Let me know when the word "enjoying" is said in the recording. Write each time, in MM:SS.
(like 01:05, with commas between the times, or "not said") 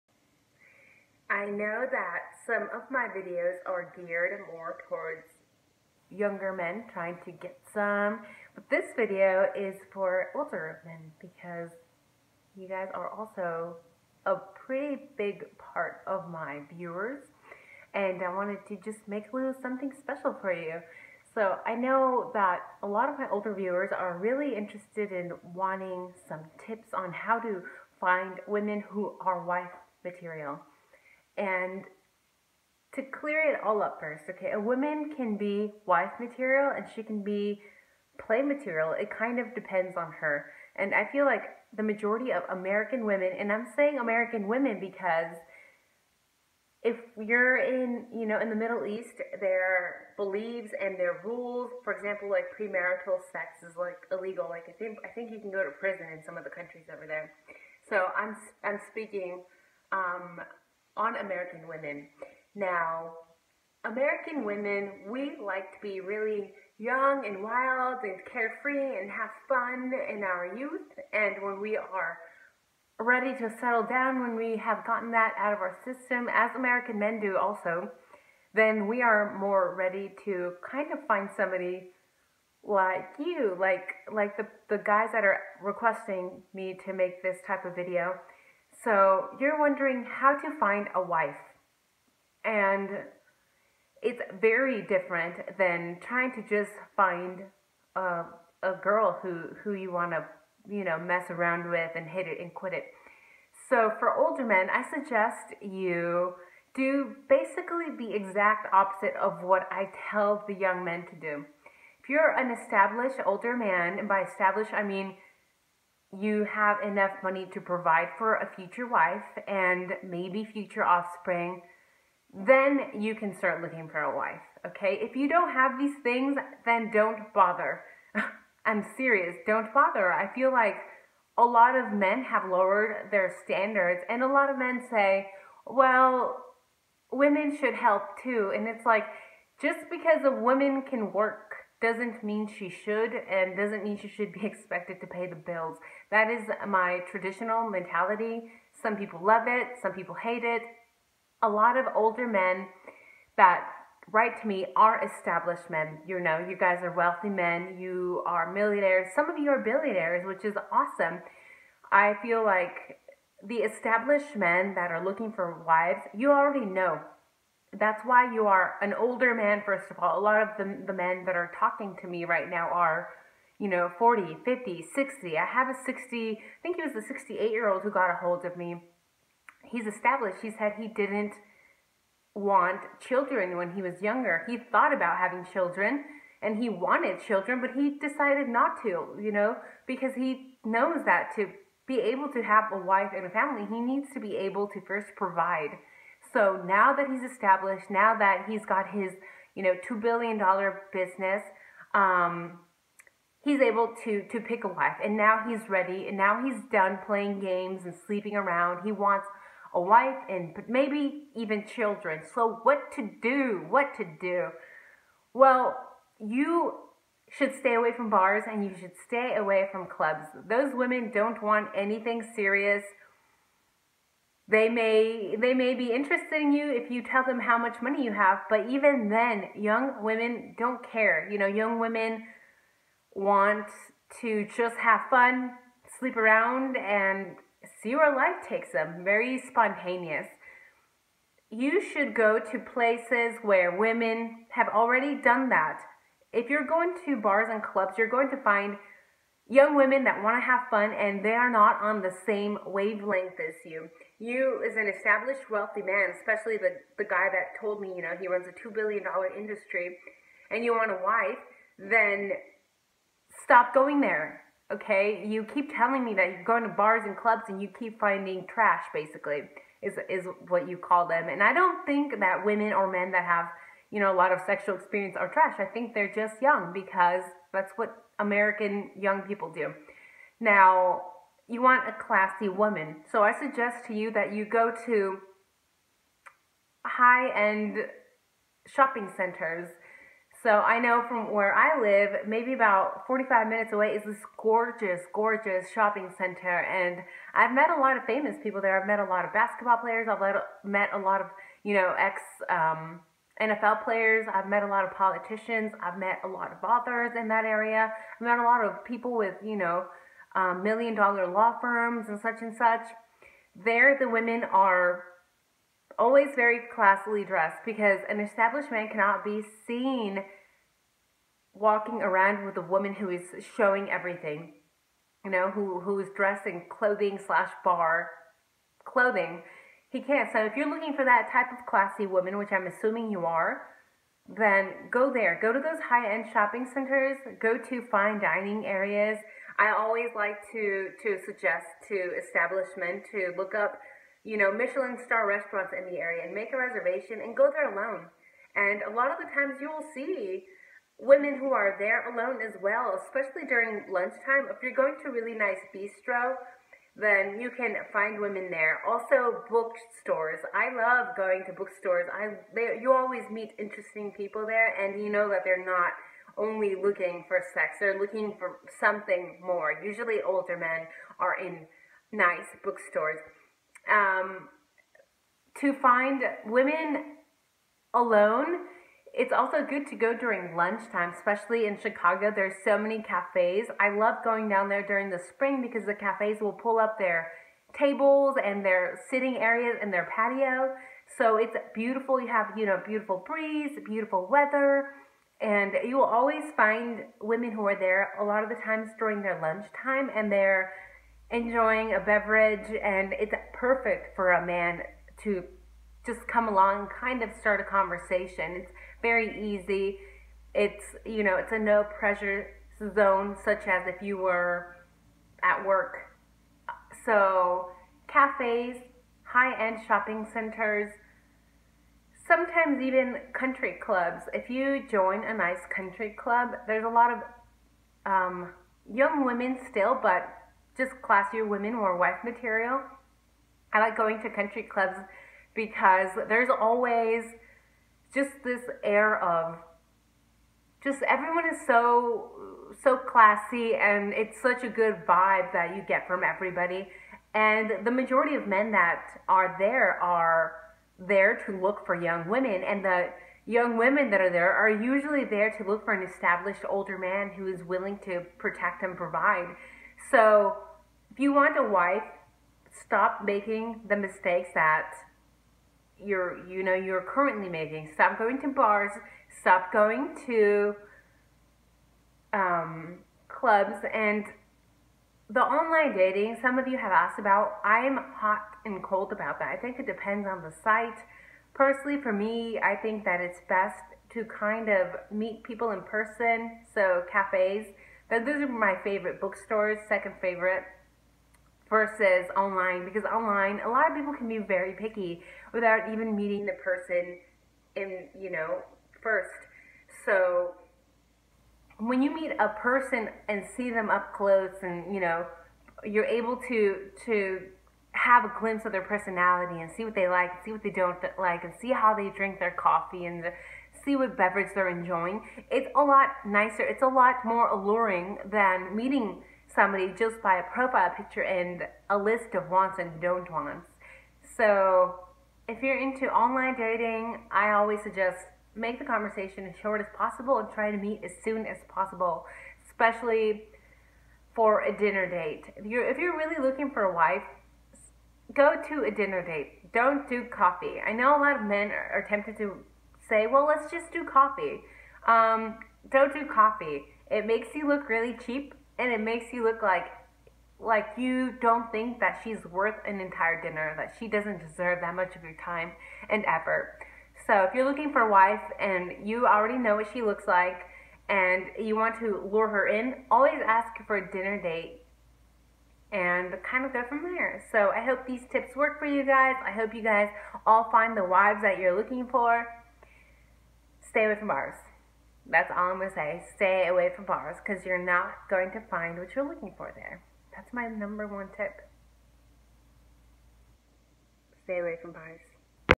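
06:41, 08:34.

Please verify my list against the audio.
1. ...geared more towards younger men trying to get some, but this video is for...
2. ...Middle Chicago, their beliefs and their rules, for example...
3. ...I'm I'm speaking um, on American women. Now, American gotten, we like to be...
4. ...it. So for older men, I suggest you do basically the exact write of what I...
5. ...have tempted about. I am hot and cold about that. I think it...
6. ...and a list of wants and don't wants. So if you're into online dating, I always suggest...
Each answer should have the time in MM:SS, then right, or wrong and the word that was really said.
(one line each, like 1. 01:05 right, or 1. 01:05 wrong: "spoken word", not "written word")
1. 00:03 right
2. 00:48 wrong: "East", not "Chicago"
3. 00:58 wrong: "women", not "gotten"
4. 01:42 wrong: "opposite", not "write"
5. 07:56 wrong: "asked", not "tempted"
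6. 08:41 right.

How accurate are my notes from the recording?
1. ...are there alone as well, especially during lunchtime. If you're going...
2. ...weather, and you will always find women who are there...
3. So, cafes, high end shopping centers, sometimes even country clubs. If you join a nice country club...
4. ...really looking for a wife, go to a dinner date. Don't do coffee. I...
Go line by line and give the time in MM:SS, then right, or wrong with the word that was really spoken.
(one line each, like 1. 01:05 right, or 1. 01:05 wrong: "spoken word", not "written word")
1. 05:51 right
2. 06:34 right
3. 06:57 right
4. 08:56 right.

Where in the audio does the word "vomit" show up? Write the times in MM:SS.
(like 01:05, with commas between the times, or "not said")
not said.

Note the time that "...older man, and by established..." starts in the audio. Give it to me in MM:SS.
01:53.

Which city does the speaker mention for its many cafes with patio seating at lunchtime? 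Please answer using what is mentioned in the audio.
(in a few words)
Chicago.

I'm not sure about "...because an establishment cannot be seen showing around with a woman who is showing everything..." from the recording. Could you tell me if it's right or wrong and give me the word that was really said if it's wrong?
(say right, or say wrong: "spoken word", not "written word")
wrong: "walking", not "showing".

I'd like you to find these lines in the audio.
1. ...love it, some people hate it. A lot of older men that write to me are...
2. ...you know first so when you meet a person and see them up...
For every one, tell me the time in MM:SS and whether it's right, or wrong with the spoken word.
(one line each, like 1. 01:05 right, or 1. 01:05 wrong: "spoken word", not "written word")
1. 02:29 right
2. 08:18 right.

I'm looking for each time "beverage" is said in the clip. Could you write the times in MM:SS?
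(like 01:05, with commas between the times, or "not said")
06:42, 08:34.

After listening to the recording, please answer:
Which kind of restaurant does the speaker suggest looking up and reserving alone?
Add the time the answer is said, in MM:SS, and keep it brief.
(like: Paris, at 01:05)
Michelin star restaurants, at 05:44.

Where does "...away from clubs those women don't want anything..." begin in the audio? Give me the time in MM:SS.
03:39.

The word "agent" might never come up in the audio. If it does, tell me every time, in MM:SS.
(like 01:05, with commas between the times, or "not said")
not said.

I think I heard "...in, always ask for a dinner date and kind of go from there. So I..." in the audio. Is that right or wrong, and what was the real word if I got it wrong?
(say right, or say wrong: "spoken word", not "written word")
right.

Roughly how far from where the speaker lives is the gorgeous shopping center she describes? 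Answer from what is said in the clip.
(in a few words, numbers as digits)
45 minutes.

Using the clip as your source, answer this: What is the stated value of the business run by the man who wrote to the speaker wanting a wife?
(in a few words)
$2 billion.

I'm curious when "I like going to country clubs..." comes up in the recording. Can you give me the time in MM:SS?
07:13.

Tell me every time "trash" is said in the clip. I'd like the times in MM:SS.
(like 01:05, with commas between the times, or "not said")
04:28, 04:35.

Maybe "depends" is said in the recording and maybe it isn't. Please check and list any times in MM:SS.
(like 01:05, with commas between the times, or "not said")
00:39, 07:59.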